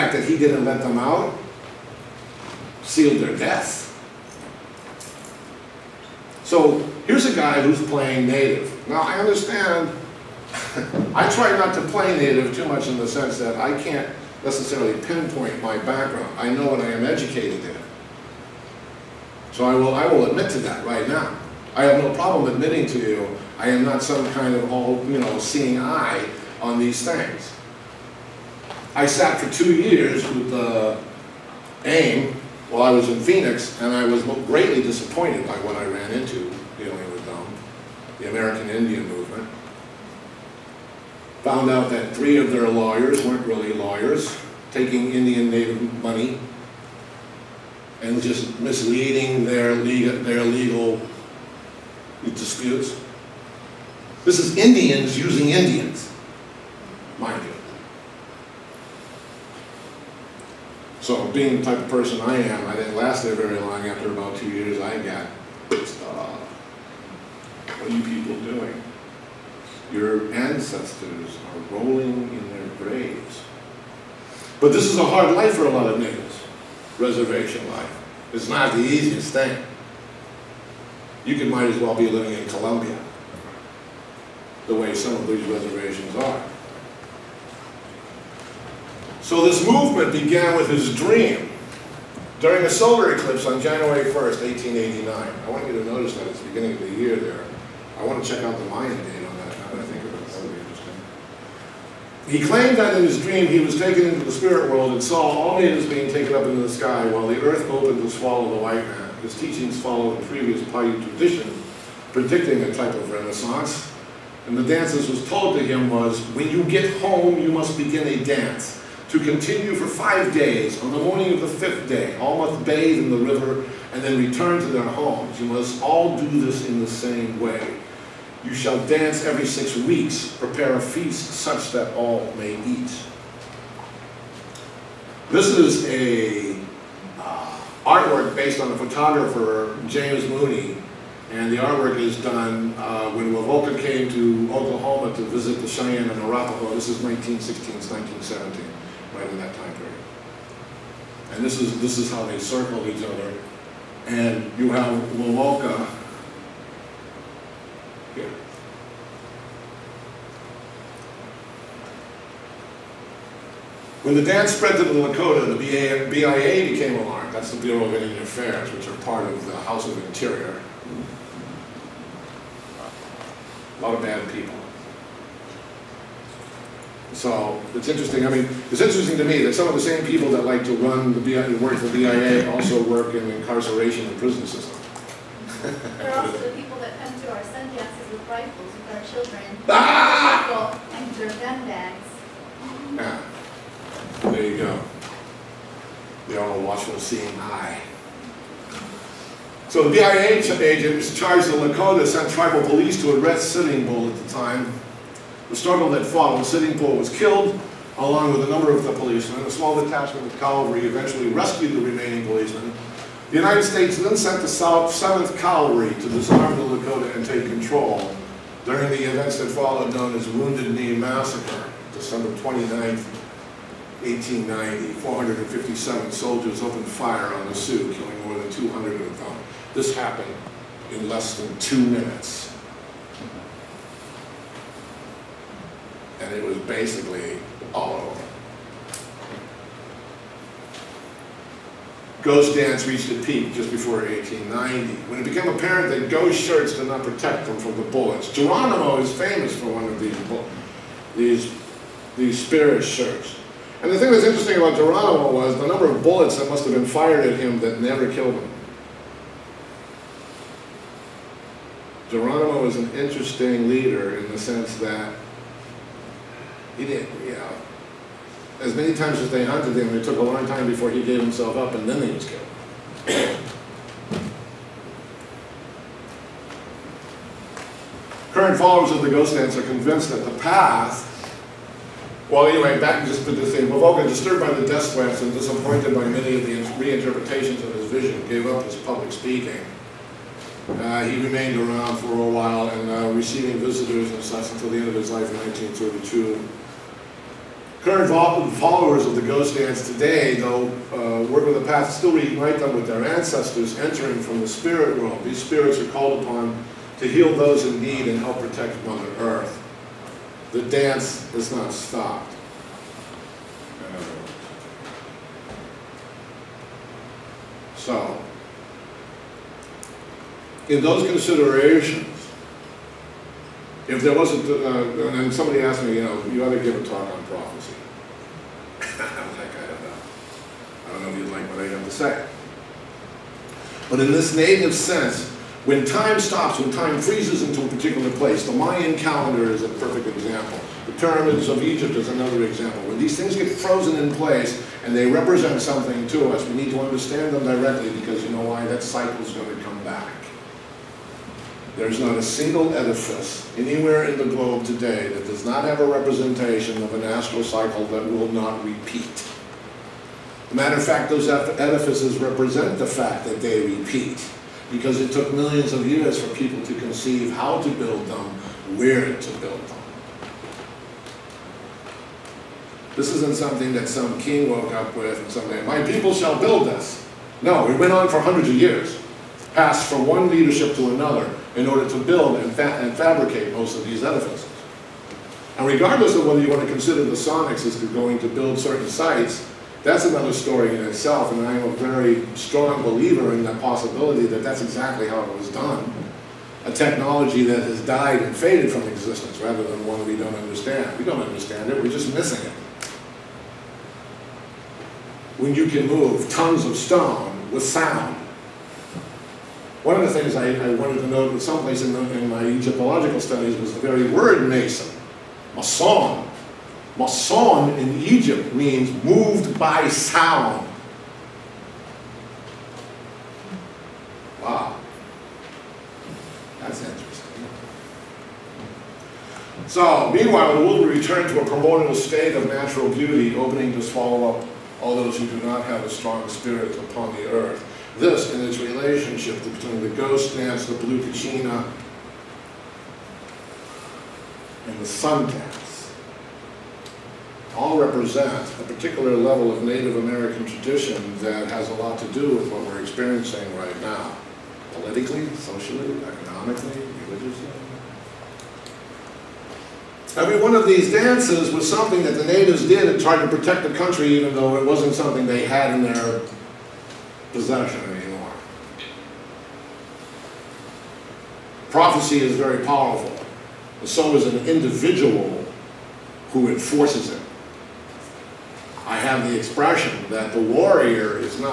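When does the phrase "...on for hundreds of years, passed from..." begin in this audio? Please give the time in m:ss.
6:17.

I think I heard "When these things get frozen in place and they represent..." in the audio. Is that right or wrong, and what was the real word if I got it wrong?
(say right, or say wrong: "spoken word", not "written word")
right.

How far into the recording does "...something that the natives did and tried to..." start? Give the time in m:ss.
7:41.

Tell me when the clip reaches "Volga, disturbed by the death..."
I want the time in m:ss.
4:43.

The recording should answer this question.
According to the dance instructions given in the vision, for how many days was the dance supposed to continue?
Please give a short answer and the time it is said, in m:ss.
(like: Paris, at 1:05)
5, at 1:59.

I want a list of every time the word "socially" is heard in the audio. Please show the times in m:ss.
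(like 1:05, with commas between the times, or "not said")
7:35.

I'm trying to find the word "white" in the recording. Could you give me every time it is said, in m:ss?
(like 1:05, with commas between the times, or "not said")
1:48.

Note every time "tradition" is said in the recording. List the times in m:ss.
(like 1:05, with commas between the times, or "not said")
1:51, 7:30.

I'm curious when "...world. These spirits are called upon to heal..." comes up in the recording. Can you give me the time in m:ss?
5:04.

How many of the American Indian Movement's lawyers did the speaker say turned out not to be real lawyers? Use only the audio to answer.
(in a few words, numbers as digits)
3.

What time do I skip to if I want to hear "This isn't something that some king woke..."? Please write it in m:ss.
6:12.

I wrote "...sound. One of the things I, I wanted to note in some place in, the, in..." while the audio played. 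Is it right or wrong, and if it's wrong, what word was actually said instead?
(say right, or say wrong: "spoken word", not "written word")
right.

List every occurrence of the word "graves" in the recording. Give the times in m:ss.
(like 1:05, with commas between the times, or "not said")
1:12.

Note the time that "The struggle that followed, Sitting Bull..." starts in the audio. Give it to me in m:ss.
3:25.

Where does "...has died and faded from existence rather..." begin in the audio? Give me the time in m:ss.
6:37.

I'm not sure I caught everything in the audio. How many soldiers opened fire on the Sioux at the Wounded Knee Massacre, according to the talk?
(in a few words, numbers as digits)
457.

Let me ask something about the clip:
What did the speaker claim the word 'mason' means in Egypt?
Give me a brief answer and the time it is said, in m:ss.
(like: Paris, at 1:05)
moved by sound, at 6:59.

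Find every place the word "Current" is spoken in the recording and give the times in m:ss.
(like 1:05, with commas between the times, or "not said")
4:38, 4:57.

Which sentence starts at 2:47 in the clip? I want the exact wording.
That's the Bureau of Indian Affairs, which are part of the House of Interior.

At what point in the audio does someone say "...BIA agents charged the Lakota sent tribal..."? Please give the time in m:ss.
3:19.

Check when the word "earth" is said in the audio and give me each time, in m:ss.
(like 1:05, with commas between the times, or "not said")
1:47, 5:09, 7:17.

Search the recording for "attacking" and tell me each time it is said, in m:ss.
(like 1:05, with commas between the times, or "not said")
not said.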